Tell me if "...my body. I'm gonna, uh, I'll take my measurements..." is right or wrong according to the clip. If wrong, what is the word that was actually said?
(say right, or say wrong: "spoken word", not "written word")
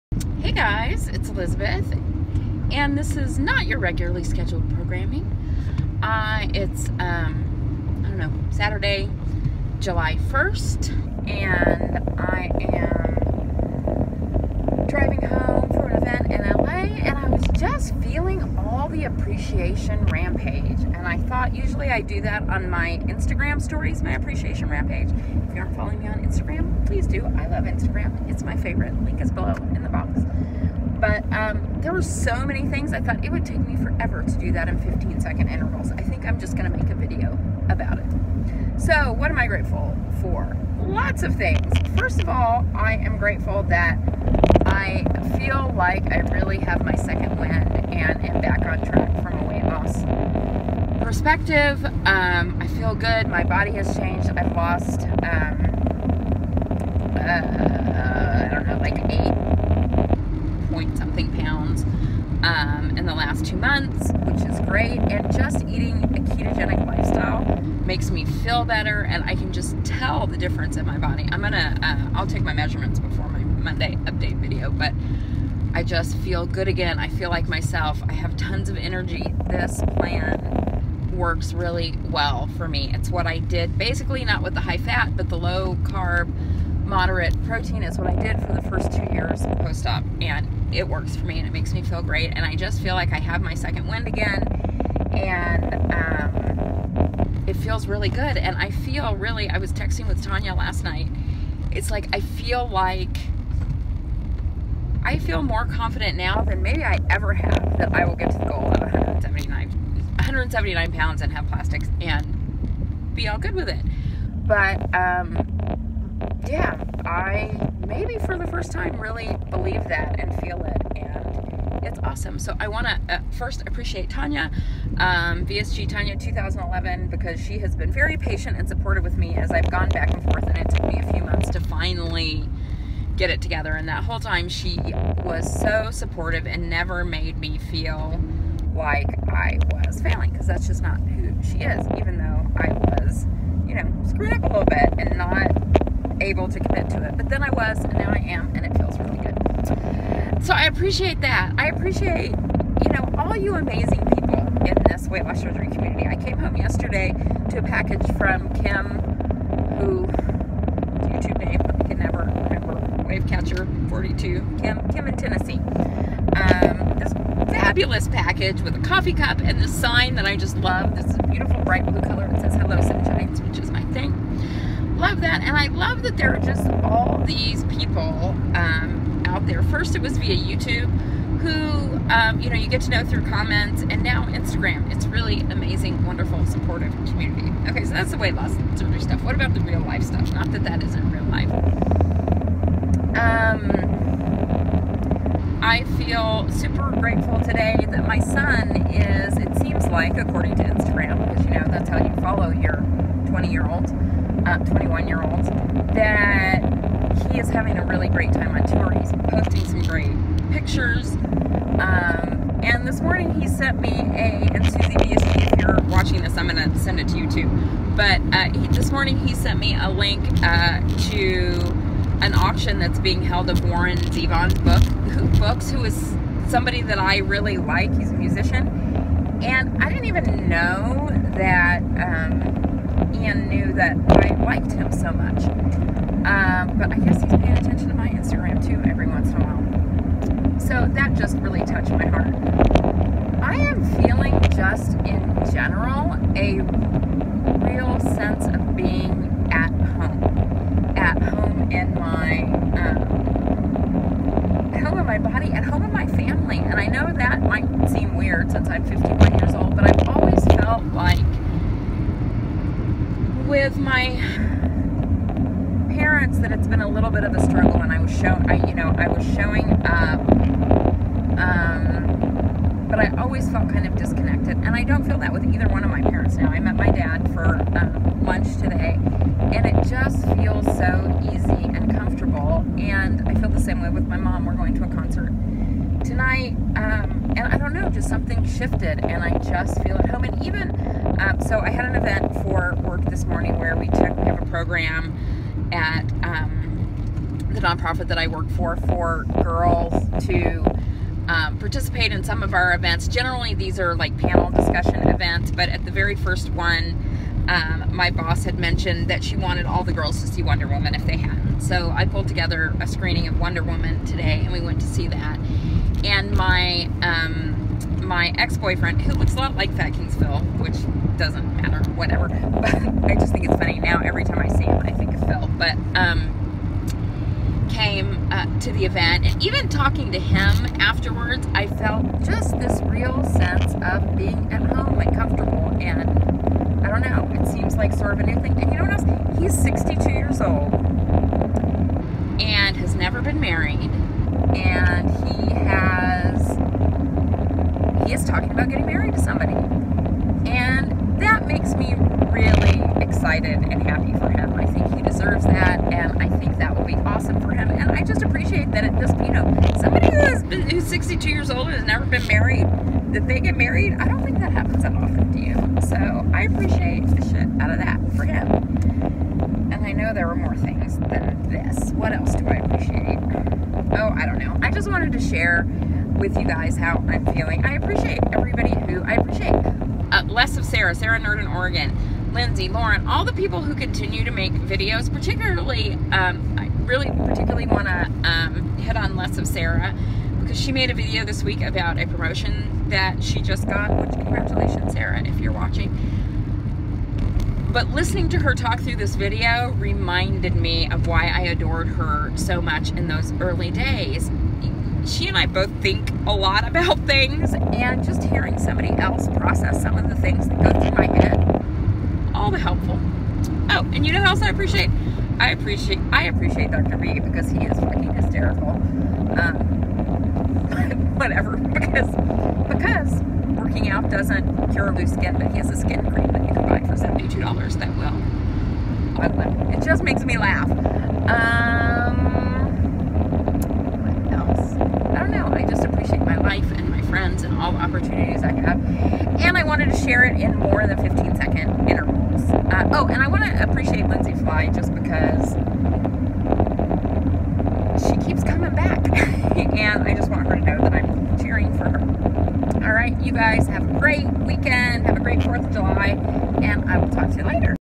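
right.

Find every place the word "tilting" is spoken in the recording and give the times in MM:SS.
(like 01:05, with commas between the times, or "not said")
not said.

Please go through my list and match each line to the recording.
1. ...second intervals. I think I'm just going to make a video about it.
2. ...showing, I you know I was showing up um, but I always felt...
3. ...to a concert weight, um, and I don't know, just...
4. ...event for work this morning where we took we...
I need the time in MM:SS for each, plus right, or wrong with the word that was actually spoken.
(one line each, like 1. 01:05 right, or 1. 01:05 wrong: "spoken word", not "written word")
1. 00:35 right
2. 04:28 right
3. 04:44 wrong: "tonight", not "weight"
4. 04:51 right.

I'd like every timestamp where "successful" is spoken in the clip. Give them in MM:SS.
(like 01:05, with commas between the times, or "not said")
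not said.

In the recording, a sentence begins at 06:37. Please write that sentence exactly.
But listening to her talk through this video reminded me of why I adored her so much in those early days.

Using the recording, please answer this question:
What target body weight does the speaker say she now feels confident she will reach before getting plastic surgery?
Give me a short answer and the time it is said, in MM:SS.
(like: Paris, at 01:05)
179 pounds, at 01:50.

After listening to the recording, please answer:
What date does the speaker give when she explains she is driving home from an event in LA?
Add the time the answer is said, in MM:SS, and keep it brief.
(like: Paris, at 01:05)
Saturday, July 1st, at 00:08.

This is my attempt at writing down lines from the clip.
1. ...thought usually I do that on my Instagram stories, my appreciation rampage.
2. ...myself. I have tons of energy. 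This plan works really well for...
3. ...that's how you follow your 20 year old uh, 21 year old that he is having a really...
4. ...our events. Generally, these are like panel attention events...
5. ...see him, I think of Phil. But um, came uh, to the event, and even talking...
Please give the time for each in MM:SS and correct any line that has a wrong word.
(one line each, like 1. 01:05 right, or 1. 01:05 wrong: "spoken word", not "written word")
1. 00:21 right
2. 01:17 right
3. 03:21 right
4. 05:02 wrong: "discussion", not "attention"
5. 05:24 right.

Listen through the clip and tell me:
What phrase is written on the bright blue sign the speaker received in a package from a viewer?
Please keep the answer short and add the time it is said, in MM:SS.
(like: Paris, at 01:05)
Hello Sunshines, at 02:52.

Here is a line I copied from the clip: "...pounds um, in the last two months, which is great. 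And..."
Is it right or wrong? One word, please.
right.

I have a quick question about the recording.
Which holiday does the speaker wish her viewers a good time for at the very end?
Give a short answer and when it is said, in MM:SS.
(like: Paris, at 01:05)
4th of July, at 07:35.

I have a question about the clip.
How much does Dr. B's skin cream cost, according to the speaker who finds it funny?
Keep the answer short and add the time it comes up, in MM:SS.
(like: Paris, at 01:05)
$72, at 07:07.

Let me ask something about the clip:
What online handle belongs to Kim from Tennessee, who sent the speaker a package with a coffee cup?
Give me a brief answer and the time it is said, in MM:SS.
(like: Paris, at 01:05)
Wave Catcher 42, at 02:43.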